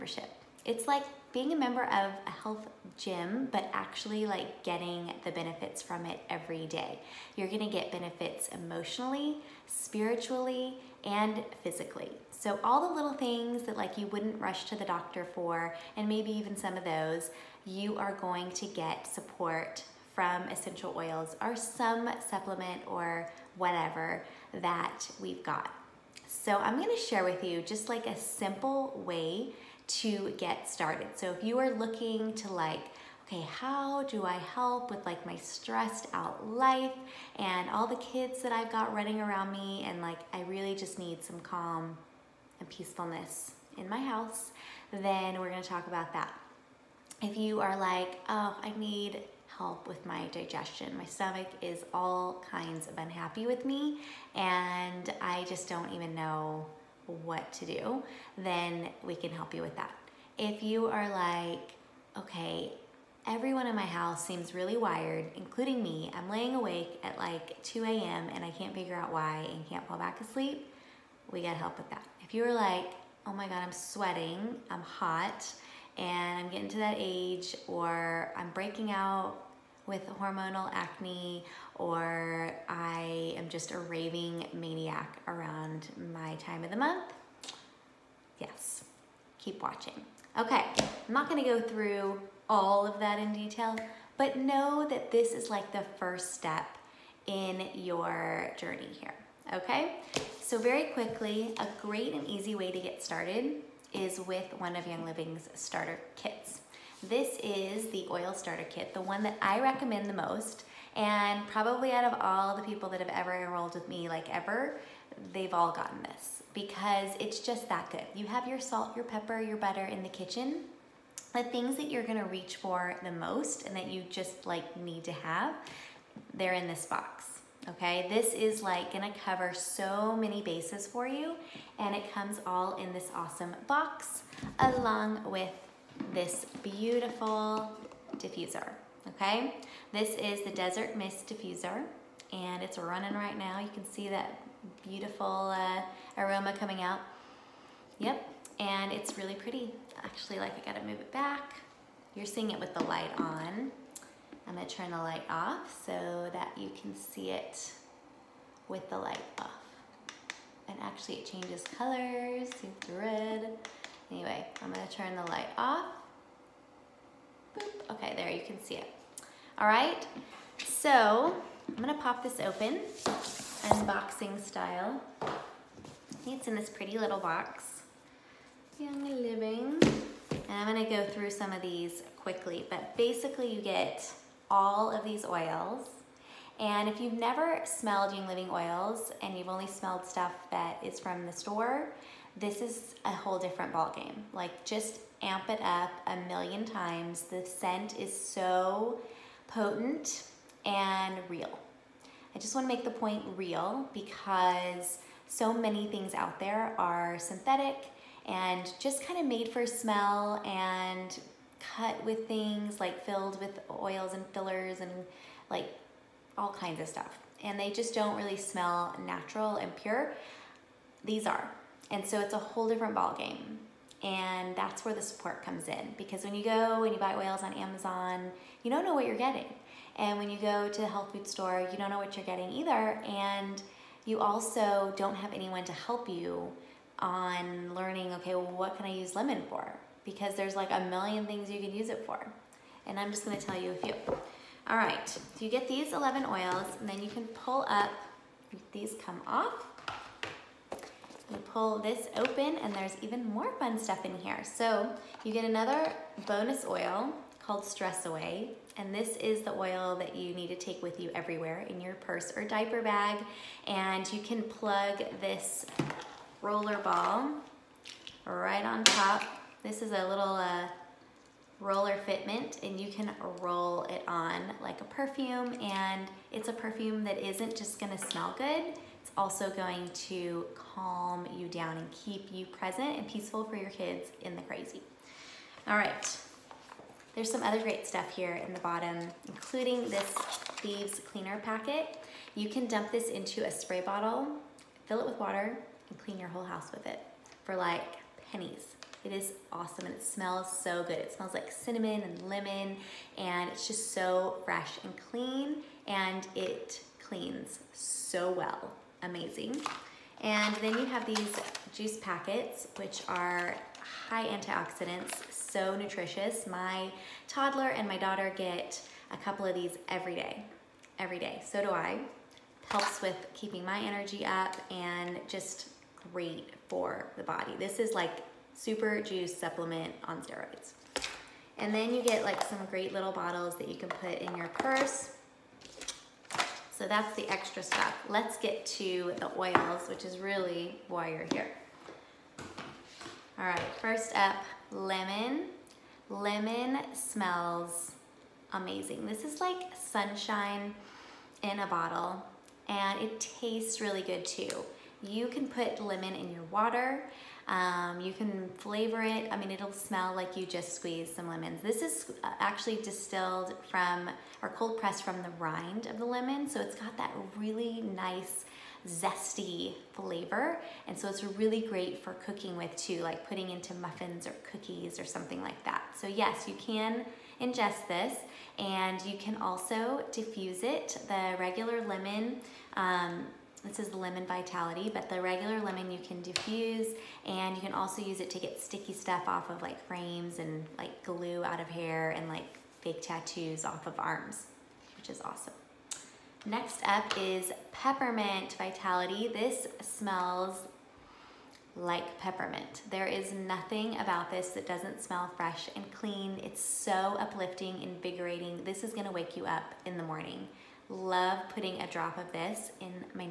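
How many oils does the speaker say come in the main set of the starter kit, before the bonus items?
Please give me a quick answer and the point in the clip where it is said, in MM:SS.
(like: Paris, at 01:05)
11, at 04:05.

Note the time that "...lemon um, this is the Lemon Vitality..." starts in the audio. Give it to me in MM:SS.
06:21.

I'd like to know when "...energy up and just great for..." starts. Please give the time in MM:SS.
05:23.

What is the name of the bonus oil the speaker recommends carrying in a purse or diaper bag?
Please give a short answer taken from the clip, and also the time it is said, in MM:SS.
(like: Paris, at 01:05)
Stress Away, at 04:17.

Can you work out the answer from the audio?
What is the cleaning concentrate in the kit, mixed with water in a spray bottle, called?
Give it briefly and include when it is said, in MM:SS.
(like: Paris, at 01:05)
Thieves Cleaner Packet, at 04:50.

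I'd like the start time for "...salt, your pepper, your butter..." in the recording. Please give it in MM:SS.
01:58.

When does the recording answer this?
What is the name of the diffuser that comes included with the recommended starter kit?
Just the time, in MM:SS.
02:20.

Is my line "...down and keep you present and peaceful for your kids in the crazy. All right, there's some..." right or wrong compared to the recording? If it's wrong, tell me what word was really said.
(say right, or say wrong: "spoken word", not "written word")
right.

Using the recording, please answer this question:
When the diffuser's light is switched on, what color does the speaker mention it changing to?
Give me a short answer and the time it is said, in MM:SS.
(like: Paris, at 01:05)
red, at 02:42.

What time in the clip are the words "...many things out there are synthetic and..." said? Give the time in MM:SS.
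03:25.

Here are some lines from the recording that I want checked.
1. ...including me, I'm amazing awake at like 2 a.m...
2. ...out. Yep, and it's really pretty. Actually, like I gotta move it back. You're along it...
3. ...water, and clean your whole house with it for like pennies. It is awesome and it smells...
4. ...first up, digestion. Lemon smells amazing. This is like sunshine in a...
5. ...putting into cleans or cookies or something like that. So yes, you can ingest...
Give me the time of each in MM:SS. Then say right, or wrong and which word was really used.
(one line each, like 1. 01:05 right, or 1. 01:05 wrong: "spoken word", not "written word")
1. 01:05 wrong: "laying", not "amazing"
2. 02:26 wrong: "seeing", not "along"
3. 04:55 right
4. 05:43 wrong: "lemon", not "digestion"
5. 06:13 wrong: "muffins", not "cleans".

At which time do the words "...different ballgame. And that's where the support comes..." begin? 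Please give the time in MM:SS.
03:42.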